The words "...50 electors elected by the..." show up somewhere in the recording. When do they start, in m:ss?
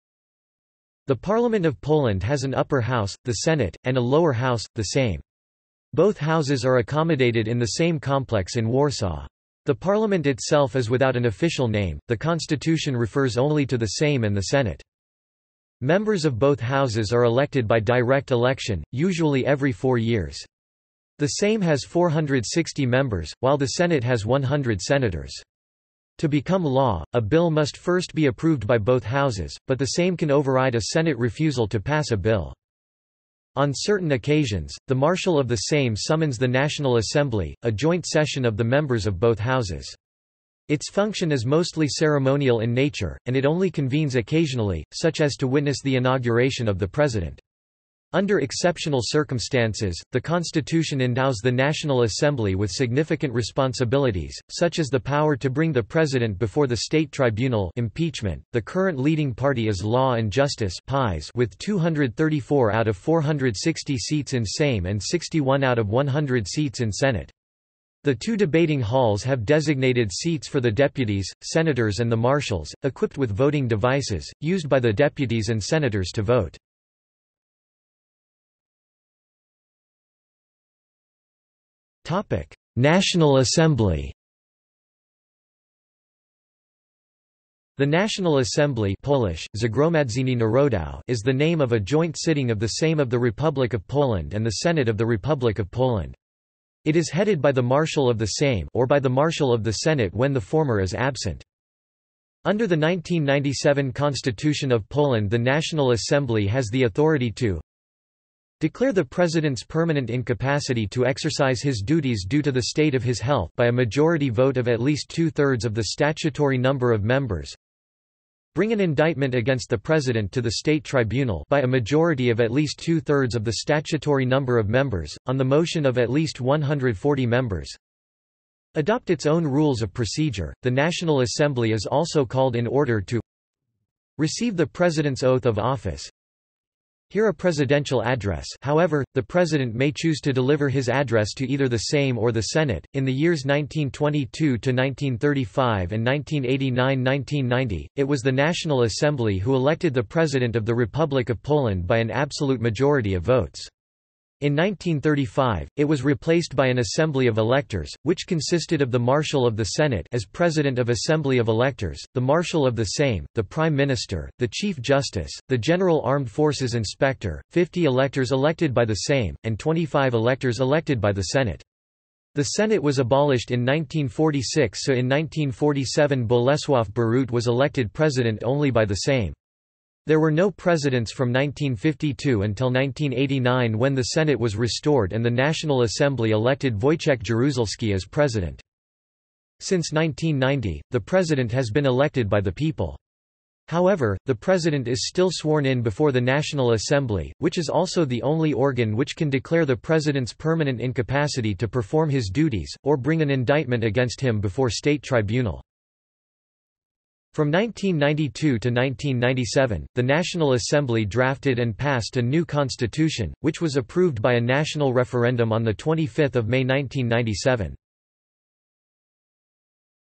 2:47.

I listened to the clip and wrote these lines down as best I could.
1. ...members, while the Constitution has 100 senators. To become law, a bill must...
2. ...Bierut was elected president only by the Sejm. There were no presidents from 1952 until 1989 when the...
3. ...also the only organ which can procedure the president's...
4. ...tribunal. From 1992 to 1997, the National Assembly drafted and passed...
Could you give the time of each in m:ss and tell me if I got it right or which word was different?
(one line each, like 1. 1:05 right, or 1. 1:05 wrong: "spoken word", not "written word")
1. 0:22 wrong: "Senate", not "Constitution"
2. 2:56 right
3. 3:17 wrong: "declare", not "procedure"
4. 3:25 right.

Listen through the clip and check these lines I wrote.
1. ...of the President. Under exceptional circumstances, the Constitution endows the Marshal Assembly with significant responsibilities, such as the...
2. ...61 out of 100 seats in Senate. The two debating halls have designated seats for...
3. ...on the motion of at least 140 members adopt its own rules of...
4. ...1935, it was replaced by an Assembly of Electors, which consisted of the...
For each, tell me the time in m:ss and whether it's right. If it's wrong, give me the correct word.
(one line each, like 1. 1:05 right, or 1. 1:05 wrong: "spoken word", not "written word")
1. 0:46 wrong: "National", not "Marshal"
2. 1:05 right
3. 2:05 right
4. 2:34 right.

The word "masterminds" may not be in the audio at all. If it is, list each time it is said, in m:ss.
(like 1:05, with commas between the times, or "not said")
not said.